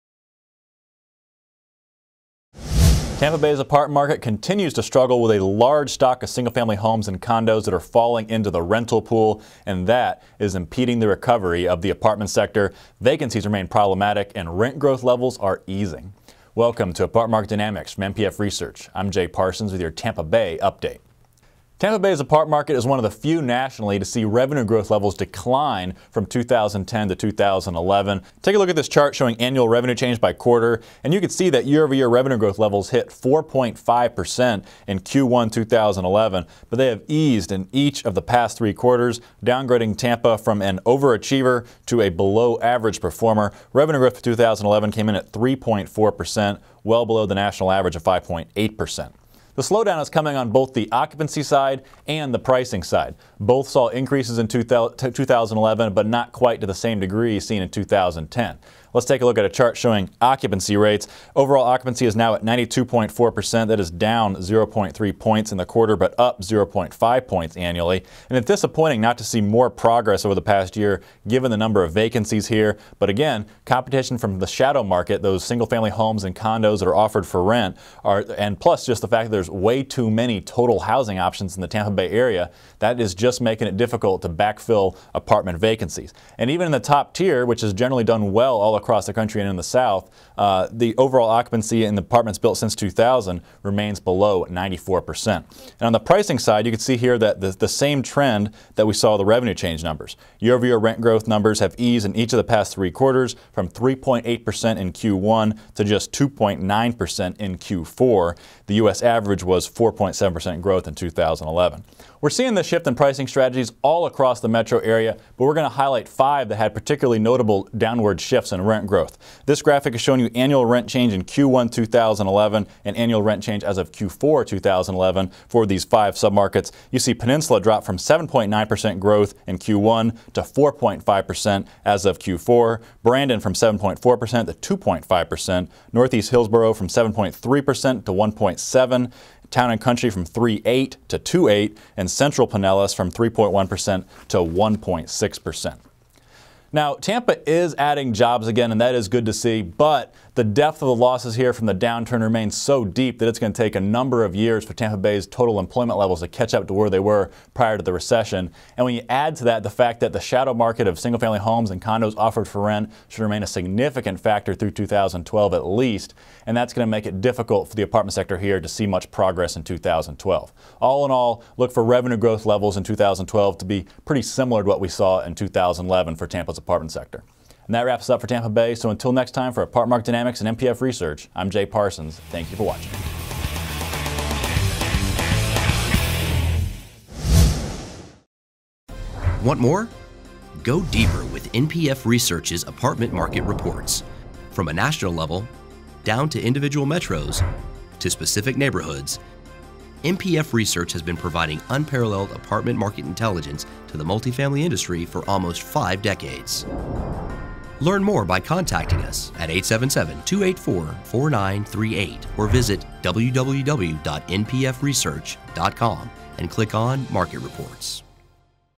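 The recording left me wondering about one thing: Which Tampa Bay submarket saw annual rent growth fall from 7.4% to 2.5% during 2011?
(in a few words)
Brandon.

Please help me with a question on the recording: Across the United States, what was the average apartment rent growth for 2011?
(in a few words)
4.7%.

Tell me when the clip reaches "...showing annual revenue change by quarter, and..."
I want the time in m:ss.
0:29.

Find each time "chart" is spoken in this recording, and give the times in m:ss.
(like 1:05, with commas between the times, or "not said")
0:28, 0:59.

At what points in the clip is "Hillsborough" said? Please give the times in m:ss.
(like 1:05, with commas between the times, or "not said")
2:16.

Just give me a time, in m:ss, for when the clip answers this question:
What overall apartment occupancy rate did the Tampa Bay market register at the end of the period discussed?
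1:02.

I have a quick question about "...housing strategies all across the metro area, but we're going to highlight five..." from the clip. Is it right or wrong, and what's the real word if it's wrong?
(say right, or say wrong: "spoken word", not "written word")
wrong: "pricing", not "housing".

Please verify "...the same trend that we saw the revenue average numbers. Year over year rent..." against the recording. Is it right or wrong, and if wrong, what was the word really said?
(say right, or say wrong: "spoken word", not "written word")
wrong: "change", not "average".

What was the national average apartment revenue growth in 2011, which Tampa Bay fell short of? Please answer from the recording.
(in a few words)
5.8%.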